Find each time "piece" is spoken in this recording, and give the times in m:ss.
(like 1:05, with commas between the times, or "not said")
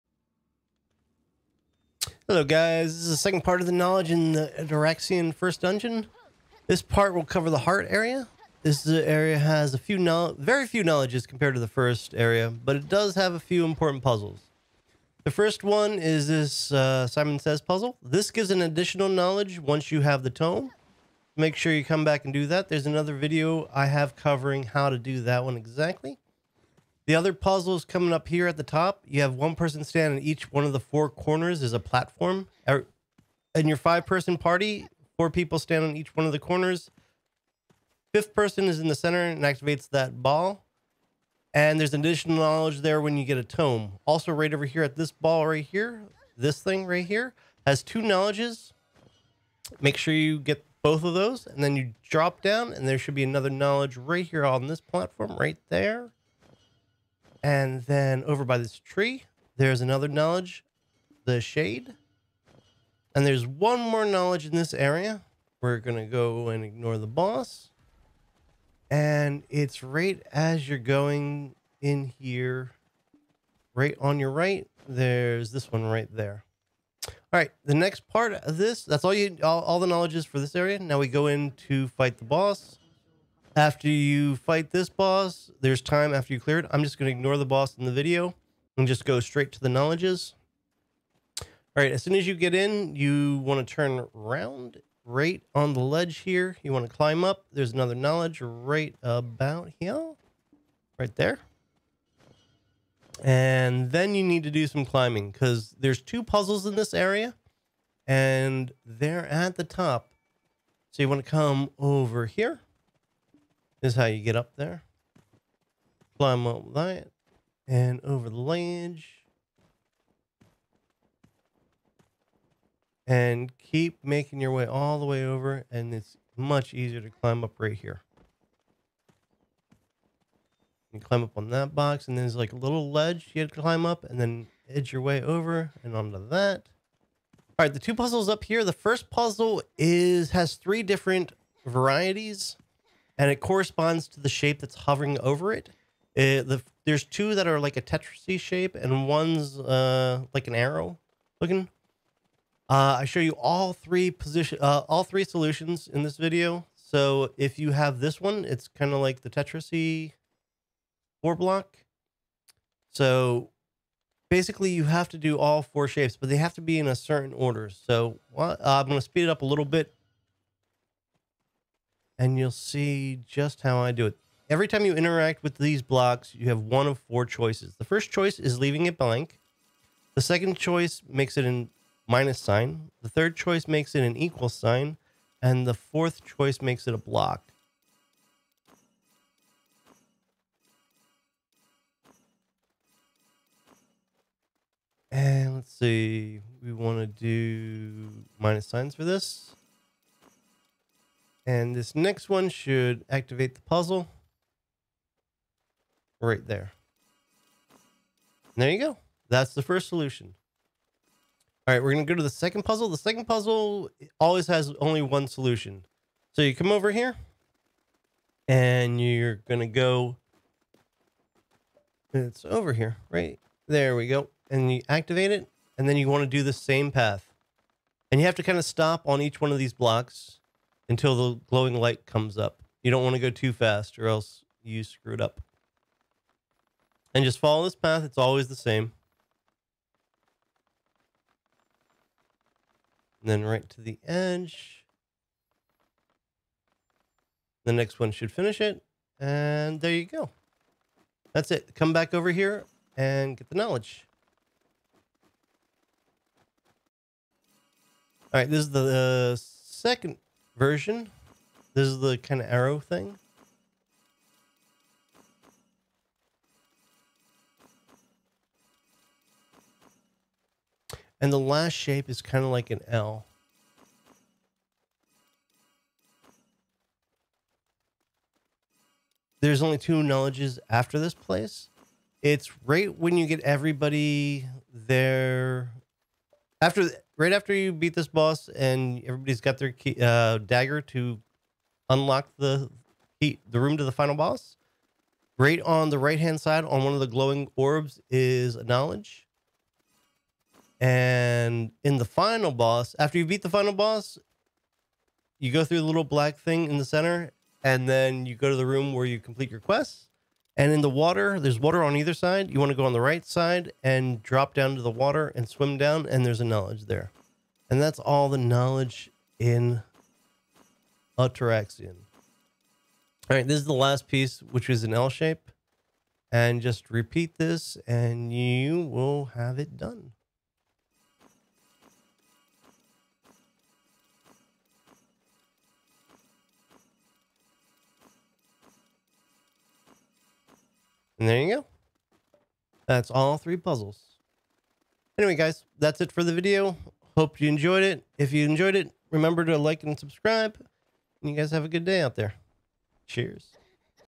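5:24.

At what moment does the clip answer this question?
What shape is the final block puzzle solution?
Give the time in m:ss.
5:24.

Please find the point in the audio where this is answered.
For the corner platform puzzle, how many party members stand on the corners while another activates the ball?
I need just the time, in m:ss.
0:35.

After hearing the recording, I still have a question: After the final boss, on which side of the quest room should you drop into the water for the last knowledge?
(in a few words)
right side.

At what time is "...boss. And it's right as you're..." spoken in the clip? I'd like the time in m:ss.
1:07.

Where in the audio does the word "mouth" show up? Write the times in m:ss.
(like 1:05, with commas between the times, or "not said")
not said.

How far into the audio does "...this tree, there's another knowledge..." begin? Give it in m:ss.
0:58.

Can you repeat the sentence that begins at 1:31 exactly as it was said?
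All right, as soon as you get in, you want to turn around right on the ledge here.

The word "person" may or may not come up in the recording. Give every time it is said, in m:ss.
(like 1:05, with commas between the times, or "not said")
0:29, 0:34, 0:38.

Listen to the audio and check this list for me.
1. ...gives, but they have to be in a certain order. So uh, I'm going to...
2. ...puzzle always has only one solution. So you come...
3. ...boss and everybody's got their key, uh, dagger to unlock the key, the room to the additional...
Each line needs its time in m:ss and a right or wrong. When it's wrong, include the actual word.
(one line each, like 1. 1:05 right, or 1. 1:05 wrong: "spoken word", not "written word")
1. 2:45 wrong: "shapes", not "gives"
2. 3:33 right
3. 4:48 wrong: "final", not "additional".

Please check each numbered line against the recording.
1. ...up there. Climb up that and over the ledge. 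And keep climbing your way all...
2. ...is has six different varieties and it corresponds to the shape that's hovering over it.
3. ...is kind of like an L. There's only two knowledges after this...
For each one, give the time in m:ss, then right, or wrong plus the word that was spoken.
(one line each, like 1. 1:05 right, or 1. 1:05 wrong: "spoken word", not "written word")
1. 1:54 wrong: "making", not "climbing"
2. 2:19 wrong: "three", not "six"
3. 4:32 right.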